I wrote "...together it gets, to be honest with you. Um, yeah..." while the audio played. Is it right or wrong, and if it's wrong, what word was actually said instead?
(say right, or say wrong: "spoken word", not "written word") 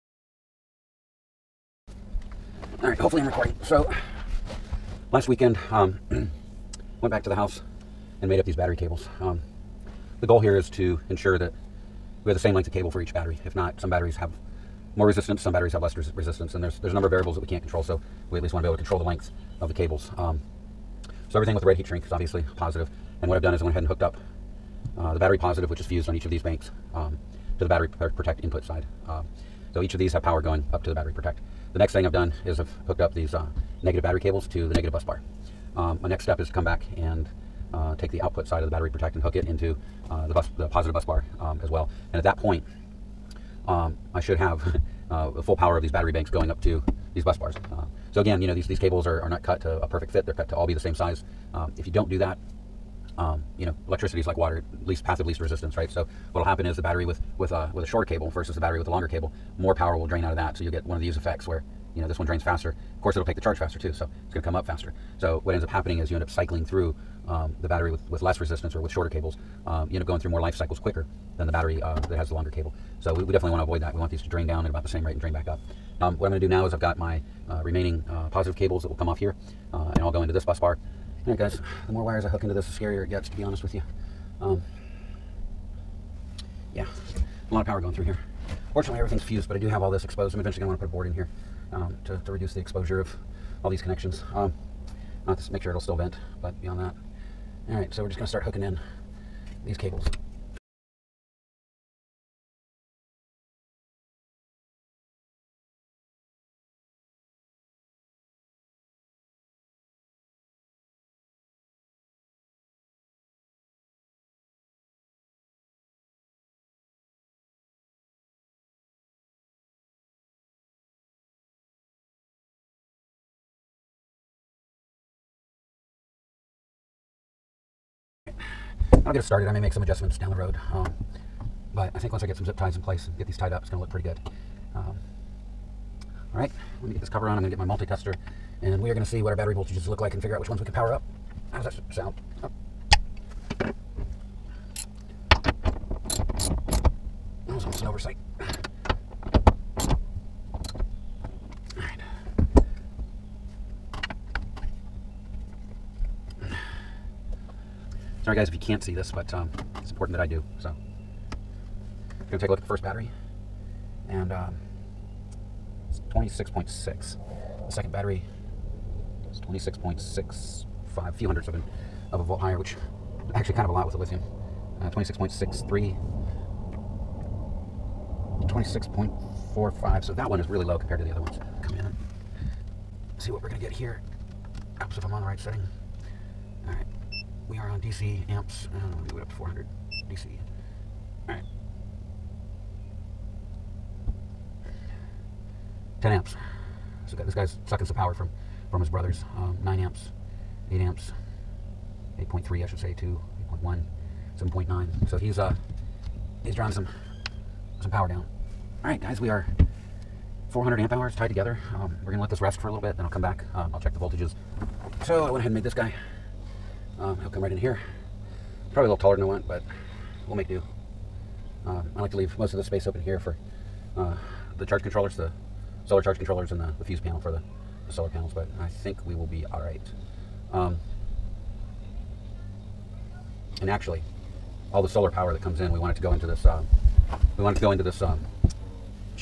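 wrong: "scarier", not "together".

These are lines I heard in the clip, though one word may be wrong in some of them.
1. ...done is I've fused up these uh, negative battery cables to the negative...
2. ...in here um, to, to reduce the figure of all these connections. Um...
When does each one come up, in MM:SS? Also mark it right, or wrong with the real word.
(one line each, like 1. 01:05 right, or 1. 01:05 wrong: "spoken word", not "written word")
1. 00:32 wrong: "hooked", not "fused"
2. 01:31 wrong: "exposure", not "figure".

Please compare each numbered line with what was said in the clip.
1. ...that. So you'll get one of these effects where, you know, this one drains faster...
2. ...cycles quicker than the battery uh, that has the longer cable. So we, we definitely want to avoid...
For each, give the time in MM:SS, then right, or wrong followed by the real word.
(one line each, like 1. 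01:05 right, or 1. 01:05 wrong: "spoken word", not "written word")
1. 01:00 right
2. 01:10 right.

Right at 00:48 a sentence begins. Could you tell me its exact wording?
So again, you know, these, these cables are, are not cut to a perfect fit.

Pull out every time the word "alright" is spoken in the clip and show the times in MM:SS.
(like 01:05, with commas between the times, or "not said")
01:37, 03:11, 03:49.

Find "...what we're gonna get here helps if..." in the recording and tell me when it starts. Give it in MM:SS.
03:03.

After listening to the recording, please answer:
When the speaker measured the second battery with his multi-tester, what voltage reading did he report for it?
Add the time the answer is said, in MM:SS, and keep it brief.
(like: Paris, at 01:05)
26.65, at 02:49.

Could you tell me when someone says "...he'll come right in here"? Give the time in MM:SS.
03:37.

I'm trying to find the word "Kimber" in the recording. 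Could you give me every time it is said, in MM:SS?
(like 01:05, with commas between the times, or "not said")
not said.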